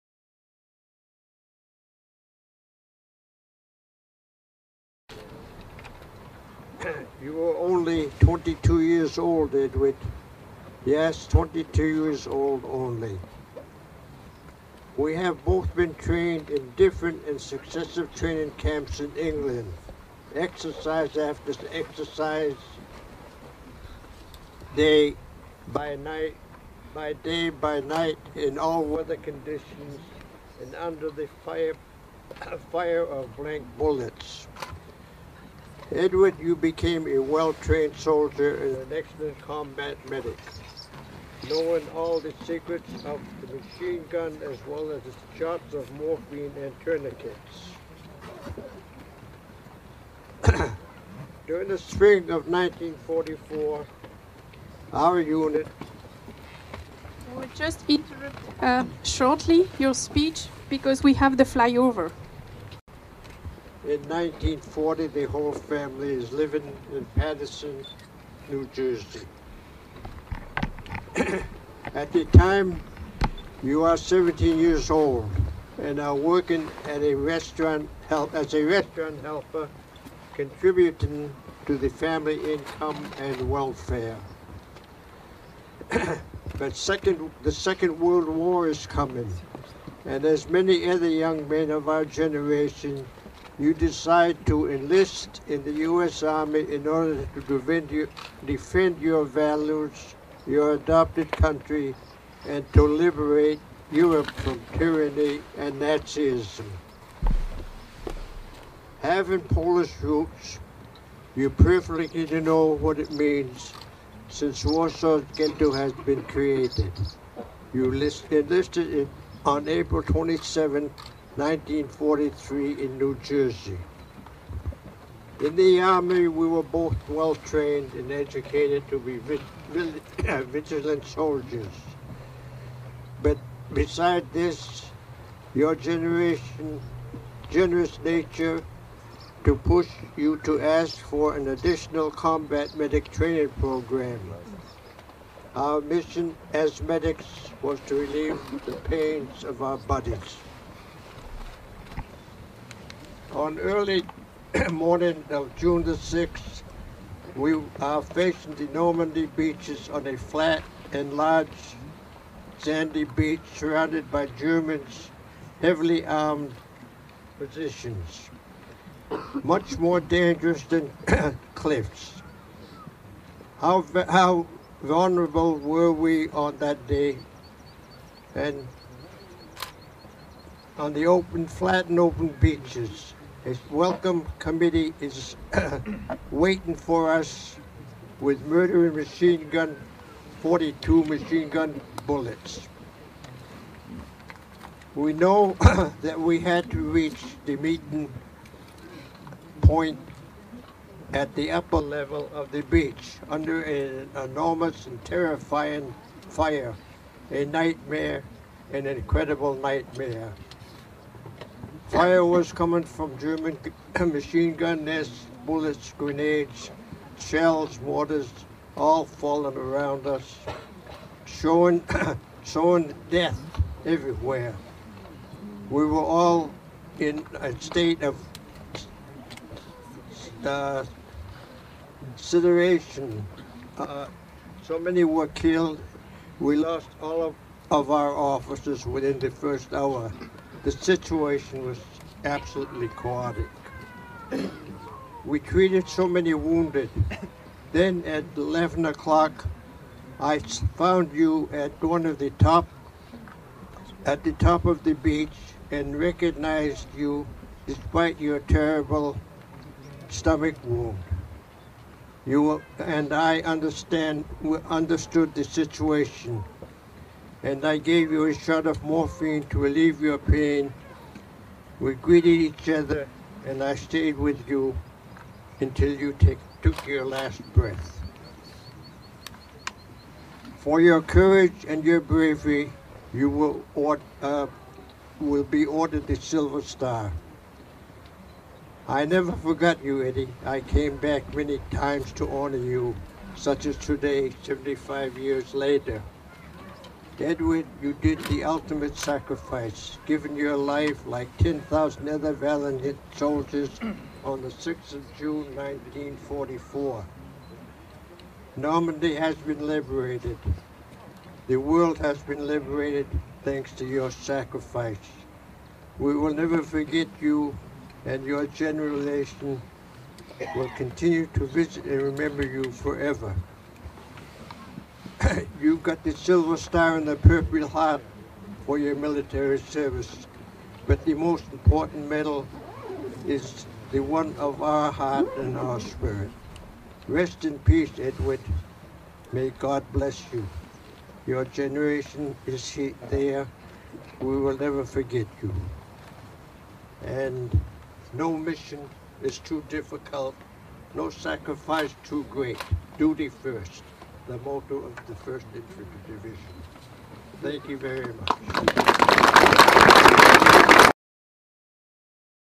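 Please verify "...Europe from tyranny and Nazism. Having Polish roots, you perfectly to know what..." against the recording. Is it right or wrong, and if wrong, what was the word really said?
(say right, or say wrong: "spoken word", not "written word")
right.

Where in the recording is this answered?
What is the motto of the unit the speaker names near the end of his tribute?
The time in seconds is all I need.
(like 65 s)
352 s.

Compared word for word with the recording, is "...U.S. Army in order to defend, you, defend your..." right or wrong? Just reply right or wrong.
right.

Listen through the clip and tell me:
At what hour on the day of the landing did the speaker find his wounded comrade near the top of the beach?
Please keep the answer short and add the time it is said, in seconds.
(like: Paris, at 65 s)
11 o'clock, at 248 s.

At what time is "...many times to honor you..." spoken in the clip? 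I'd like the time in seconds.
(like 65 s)
291 s.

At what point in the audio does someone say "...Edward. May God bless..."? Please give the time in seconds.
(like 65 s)
337 s.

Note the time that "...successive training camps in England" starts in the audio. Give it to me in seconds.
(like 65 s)
17 s.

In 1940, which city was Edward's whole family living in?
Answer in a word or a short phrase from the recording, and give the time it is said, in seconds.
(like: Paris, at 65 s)
Paterson, New Jersey, at 67 s.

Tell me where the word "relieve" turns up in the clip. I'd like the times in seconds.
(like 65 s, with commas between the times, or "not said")
147 s, 269 s.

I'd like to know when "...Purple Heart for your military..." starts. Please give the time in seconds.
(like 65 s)
327 s.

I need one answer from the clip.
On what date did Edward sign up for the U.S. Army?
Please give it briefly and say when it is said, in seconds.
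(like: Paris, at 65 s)
April 27, 1943, at 119 s.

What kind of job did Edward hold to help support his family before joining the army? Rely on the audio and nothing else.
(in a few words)
Restaurant helper.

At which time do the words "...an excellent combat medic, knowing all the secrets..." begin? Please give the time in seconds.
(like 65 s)
38 s.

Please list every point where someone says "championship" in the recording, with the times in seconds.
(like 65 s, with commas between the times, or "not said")
not said.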